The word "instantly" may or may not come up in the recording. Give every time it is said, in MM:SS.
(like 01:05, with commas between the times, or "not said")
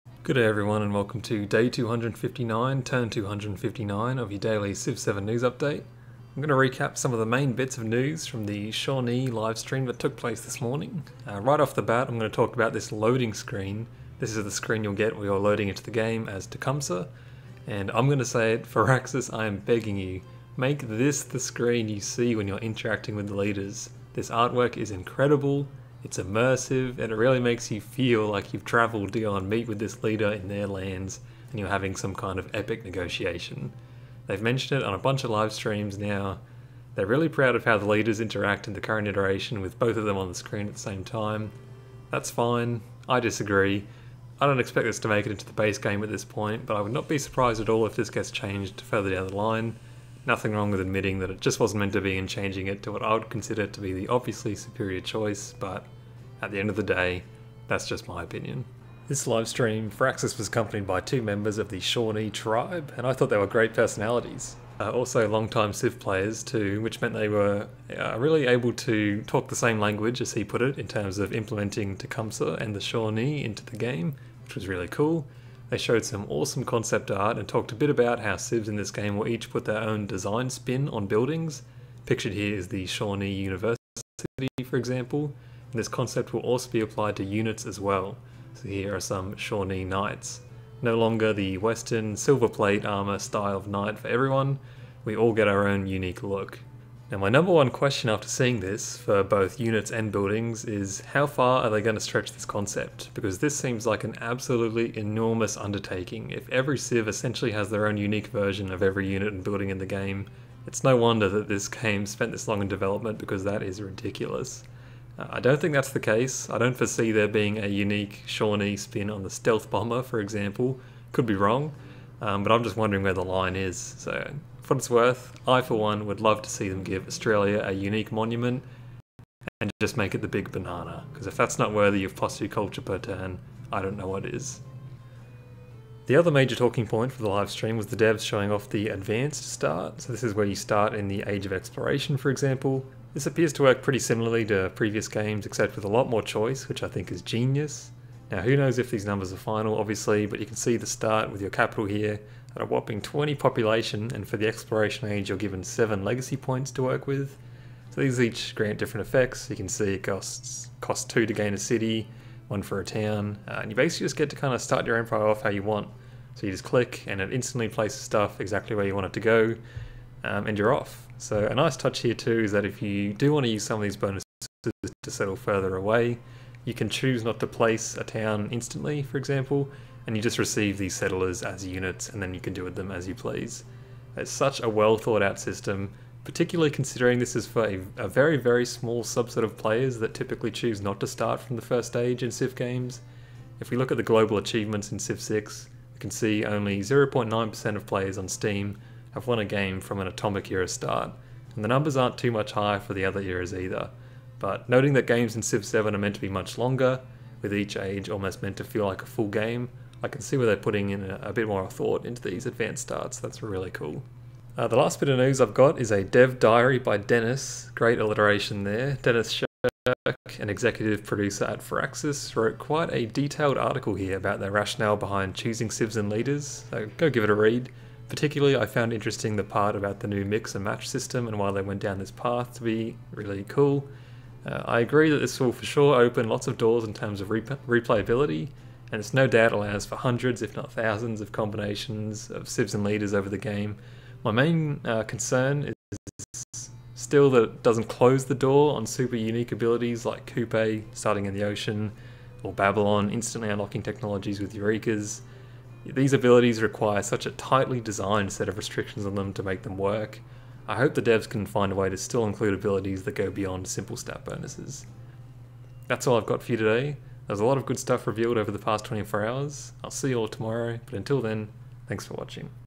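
02:47, 02:58, 04:13.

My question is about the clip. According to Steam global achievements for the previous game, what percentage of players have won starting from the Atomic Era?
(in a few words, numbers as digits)
0.9%.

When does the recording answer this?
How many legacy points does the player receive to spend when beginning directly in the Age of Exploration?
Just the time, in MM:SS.
02:35.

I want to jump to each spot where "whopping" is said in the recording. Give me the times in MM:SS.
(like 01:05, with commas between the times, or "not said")
02:32.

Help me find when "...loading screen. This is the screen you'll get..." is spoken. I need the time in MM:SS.
00:12.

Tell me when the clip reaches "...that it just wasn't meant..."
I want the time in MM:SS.
00:51.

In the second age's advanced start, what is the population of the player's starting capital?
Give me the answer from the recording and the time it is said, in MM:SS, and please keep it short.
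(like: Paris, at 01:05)
20, at 02:33.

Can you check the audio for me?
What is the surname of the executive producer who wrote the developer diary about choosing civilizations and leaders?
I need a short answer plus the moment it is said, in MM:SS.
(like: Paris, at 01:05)
Shirk, at 03:39.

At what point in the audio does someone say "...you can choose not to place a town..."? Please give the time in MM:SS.
02:56.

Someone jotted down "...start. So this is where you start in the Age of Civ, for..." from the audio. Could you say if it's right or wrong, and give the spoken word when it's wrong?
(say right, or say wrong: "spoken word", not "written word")
wrong: "Exploration", not "Civ".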